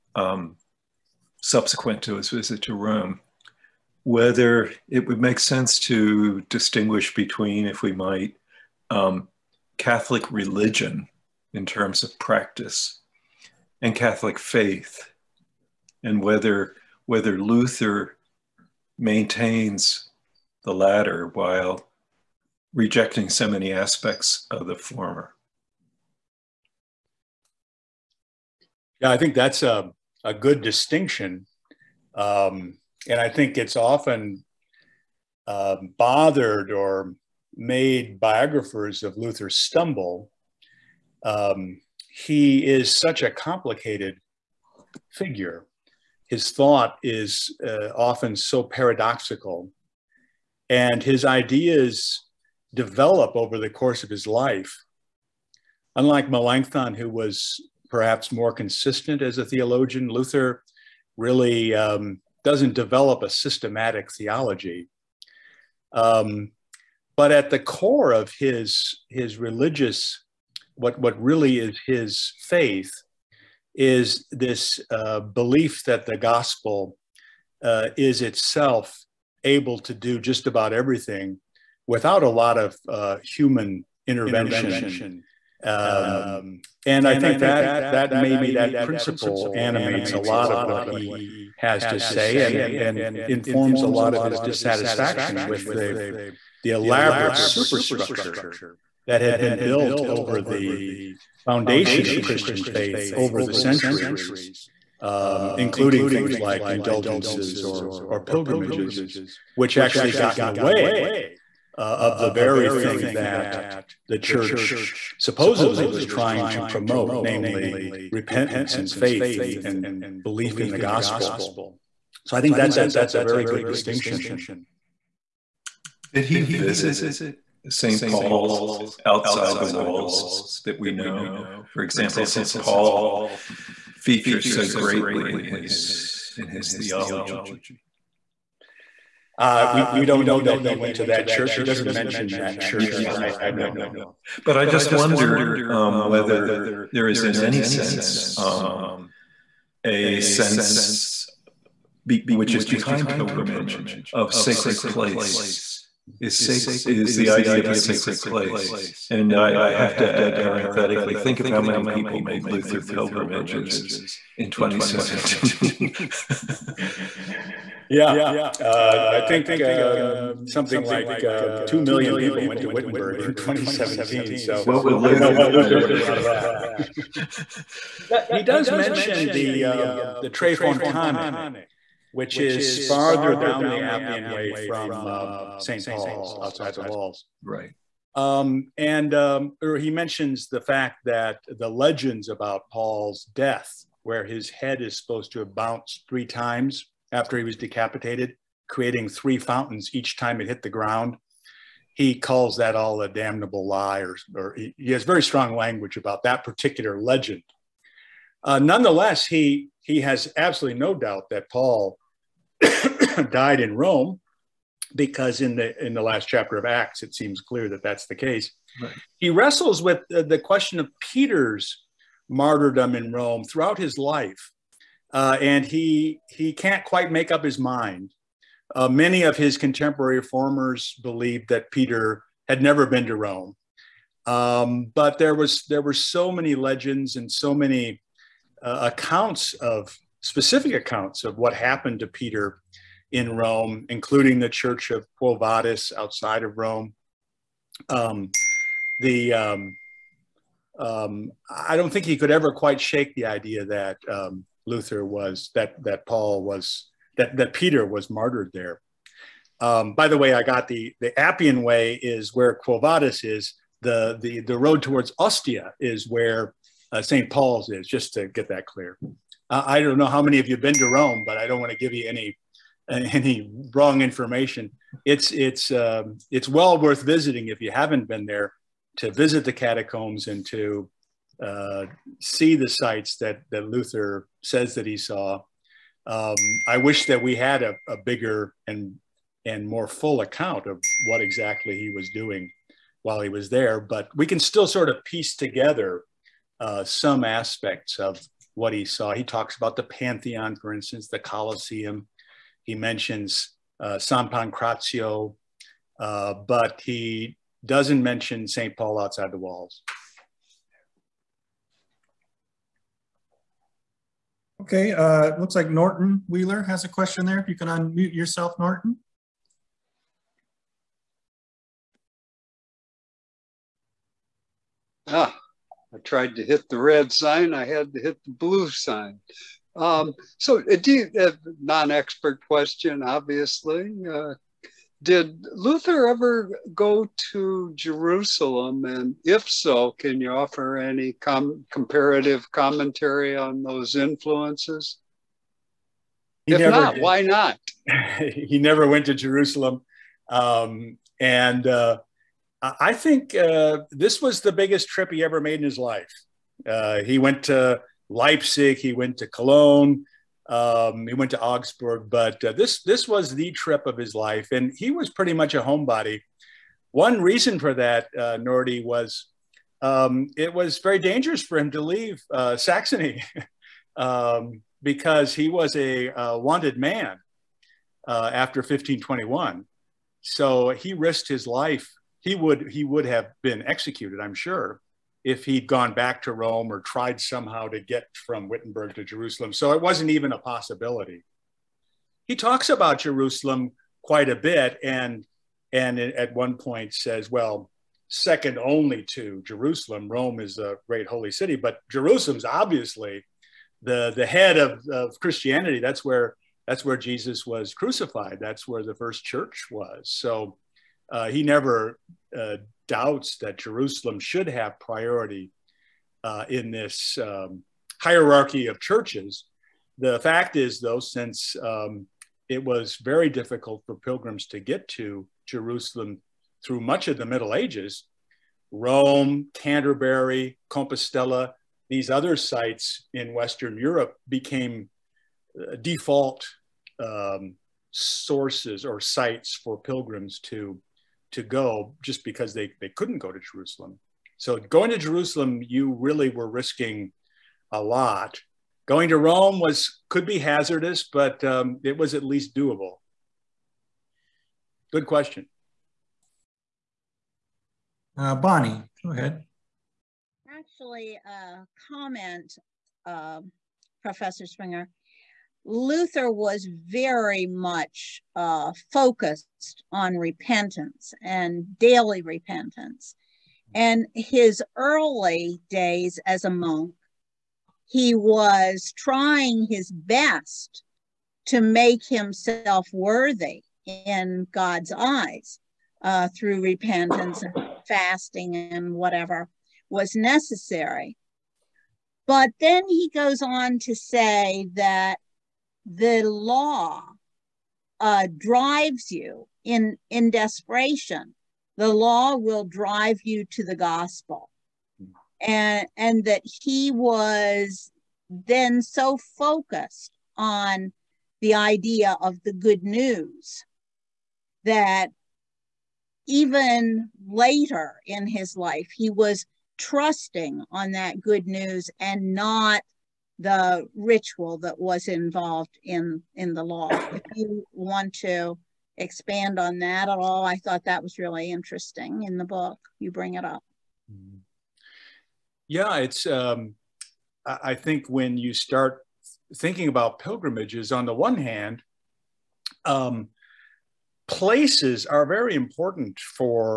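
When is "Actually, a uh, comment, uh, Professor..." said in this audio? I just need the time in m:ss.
7:40.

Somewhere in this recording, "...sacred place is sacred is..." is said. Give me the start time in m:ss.
2:34.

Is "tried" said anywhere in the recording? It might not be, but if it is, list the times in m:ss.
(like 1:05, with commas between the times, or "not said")
5:25, 6:26.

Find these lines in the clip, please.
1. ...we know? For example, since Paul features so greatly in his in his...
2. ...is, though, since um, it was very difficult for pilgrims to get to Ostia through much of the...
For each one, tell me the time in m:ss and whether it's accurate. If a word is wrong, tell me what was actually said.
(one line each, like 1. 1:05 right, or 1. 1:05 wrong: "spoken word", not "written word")
1. 2:10 right
2. 7:00 wrong: "Jerusalem", not "Ostia".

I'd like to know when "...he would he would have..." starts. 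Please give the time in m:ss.
6:22.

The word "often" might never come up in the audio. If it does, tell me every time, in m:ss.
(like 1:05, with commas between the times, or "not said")
0:33, 0:47.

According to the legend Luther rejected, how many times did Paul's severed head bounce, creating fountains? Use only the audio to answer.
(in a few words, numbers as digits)
3.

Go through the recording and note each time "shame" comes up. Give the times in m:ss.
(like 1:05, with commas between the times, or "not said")
not said.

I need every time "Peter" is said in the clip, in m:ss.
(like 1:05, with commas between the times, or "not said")
3:41, 3:51, 4:02, 4:17.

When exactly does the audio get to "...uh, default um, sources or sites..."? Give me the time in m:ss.
7:15.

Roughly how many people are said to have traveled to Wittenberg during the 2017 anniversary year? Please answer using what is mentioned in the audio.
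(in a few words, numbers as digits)
2 million.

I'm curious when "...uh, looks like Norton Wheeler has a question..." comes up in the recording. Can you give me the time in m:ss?
5:14.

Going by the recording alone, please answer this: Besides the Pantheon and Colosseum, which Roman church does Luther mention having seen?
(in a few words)
San Pancrazio.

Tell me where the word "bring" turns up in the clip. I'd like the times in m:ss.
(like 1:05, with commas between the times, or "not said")
8:53.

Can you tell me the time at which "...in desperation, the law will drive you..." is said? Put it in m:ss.
8:20.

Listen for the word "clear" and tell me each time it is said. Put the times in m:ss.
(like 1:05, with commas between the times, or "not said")
3:37, 4:28.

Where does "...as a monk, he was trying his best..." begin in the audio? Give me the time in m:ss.
7:56.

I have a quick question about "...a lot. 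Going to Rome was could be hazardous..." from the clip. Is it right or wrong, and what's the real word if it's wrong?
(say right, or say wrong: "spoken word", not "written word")
right.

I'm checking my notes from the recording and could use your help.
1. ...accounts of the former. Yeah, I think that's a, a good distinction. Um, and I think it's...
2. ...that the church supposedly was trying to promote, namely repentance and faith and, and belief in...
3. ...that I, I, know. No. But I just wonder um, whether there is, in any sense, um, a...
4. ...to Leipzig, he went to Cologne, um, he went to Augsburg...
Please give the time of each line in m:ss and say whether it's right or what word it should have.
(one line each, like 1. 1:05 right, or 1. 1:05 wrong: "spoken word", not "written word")
1. 0:23 wrong: "aspects", not "accounts"
2. 1:53 right
3. 2:23 right
4. 5:57 right.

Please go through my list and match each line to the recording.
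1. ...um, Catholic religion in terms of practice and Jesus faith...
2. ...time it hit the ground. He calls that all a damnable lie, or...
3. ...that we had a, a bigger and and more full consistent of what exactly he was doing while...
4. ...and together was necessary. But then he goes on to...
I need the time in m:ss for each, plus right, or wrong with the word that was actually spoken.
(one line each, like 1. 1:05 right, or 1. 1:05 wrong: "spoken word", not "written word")
1. 0:08 wrong: "Catholic", not "Jesus"
2. 3:20 right
3. 4:47 wrong: "account", not "consistent"
4. 8:08 wrong: "whatever", not "together".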